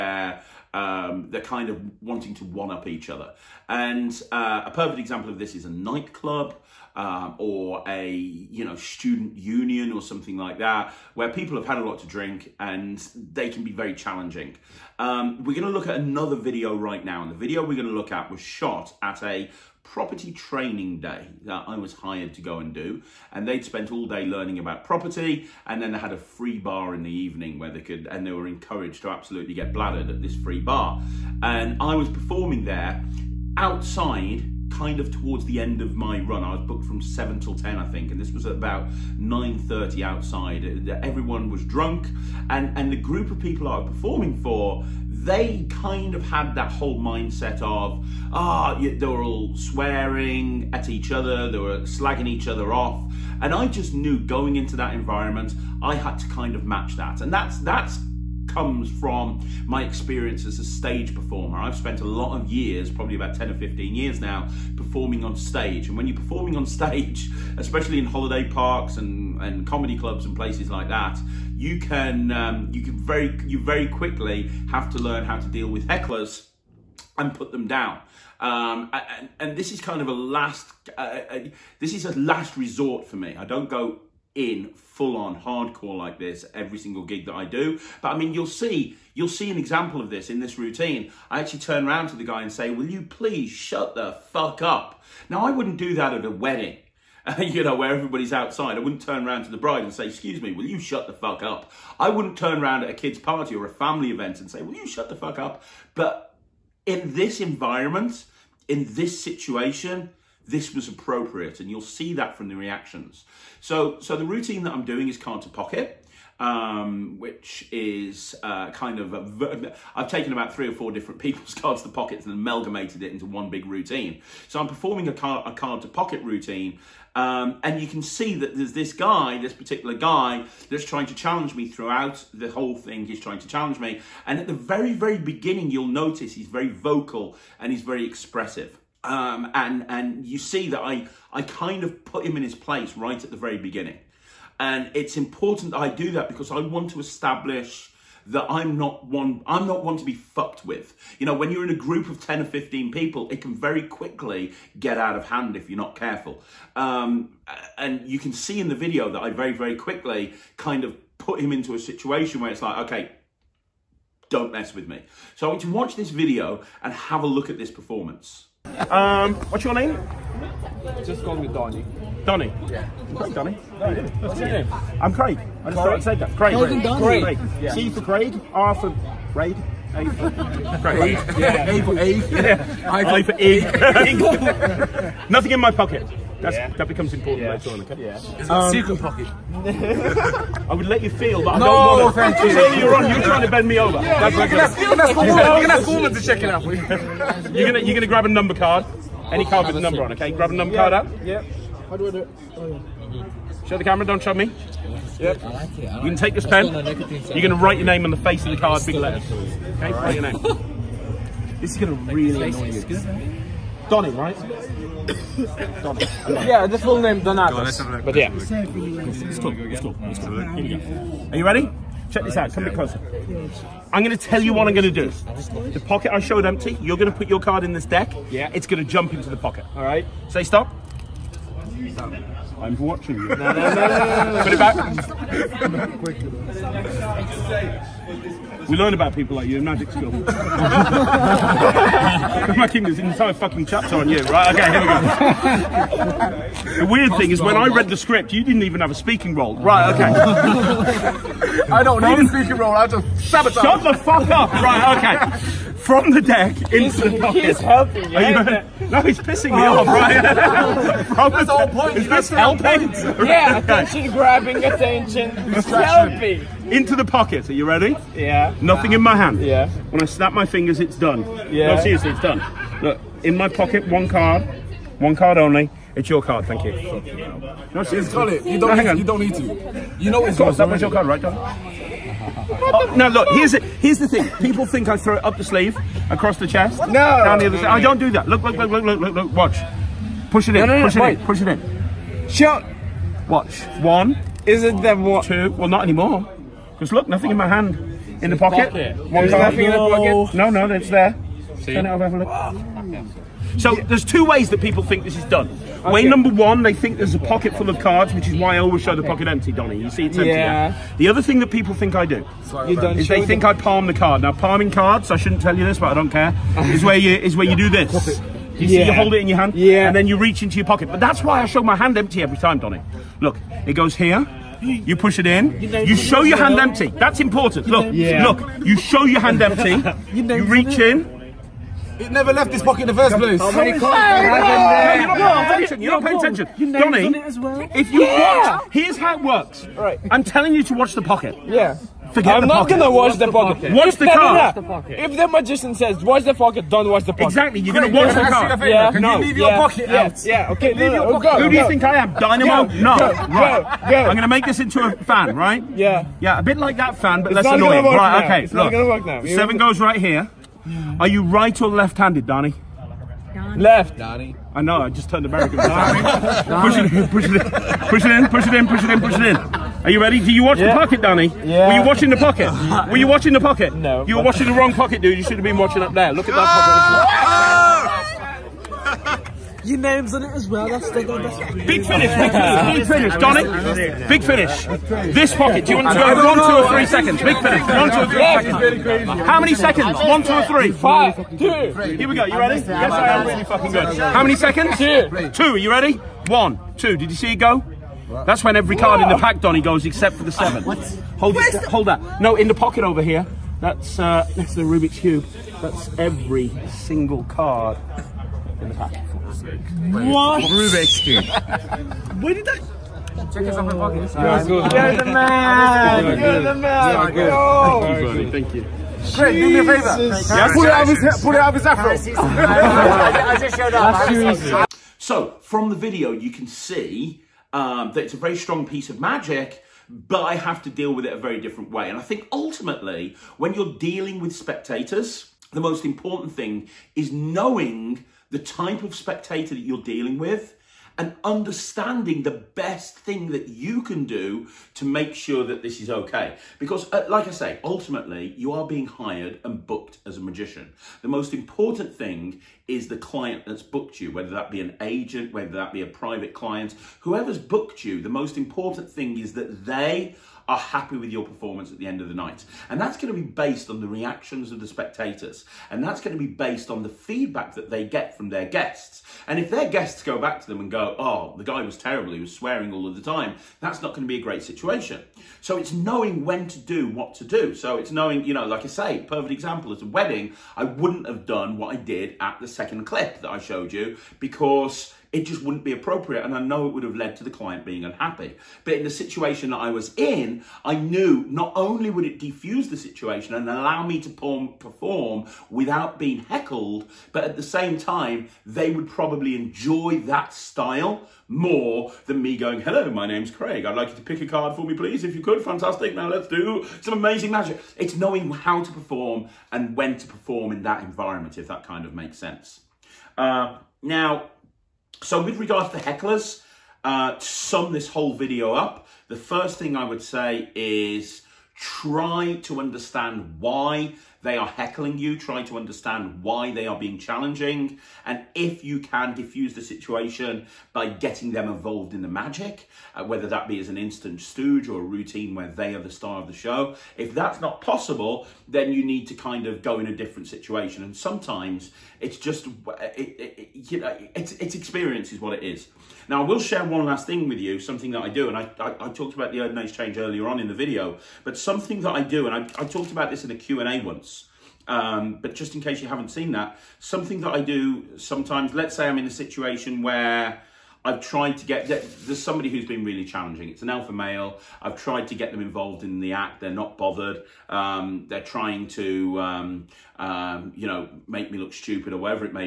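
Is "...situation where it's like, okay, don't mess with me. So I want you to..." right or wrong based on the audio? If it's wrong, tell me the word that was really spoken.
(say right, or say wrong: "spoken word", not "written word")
right.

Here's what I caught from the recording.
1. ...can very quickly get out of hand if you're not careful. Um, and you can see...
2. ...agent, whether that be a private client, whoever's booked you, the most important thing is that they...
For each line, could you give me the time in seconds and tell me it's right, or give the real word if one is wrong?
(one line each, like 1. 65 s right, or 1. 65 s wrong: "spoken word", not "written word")
1. 153 s right
2. 454 s right.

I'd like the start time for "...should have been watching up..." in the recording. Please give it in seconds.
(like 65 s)
375 s.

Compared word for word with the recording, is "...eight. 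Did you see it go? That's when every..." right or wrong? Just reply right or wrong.
wrong.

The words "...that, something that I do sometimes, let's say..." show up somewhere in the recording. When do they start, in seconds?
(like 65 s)
556 s.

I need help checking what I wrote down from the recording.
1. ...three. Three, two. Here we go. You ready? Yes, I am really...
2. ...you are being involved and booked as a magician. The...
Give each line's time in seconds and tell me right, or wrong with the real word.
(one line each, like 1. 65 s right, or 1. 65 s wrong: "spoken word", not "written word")
1. 390 s wrong: "Five", not "Three"
2. 448 s wrong: "hired", not "involved".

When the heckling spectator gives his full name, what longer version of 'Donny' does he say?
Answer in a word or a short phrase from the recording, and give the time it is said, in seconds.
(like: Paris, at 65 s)
Donatus, at 217 s.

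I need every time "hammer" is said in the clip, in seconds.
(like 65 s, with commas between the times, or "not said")
not said.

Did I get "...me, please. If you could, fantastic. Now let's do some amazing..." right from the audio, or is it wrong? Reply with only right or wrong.
right.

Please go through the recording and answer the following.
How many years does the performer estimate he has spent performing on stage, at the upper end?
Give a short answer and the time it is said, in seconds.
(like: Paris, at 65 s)
15, at 63 s.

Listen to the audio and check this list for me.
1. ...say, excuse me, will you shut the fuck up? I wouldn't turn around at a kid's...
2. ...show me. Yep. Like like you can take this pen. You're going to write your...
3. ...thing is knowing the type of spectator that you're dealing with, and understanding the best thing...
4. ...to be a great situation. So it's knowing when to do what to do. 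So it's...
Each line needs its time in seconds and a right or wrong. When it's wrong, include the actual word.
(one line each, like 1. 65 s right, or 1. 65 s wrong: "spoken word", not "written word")
1. 99 s right
2. 204 s right
3. 436 s right
4. 474 s right.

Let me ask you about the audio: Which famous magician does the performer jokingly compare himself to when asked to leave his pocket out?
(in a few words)
Dynamo.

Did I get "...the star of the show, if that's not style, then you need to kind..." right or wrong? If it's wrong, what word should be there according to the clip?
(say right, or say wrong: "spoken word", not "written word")
wrong: "possible", not "style".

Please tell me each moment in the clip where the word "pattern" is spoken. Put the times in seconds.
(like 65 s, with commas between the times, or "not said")
not said.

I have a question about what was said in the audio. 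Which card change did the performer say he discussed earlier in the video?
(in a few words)
Erdnase change.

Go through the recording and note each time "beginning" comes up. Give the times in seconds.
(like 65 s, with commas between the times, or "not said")
135 s, 143 s.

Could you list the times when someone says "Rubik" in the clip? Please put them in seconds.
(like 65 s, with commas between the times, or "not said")
404 s, 410 s.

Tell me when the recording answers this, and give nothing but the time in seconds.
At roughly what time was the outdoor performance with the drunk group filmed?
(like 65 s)
39 s.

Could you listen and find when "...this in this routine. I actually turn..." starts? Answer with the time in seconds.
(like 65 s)
90 s.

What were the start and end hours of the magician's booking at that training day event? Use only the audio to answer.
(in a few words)
7 till 10.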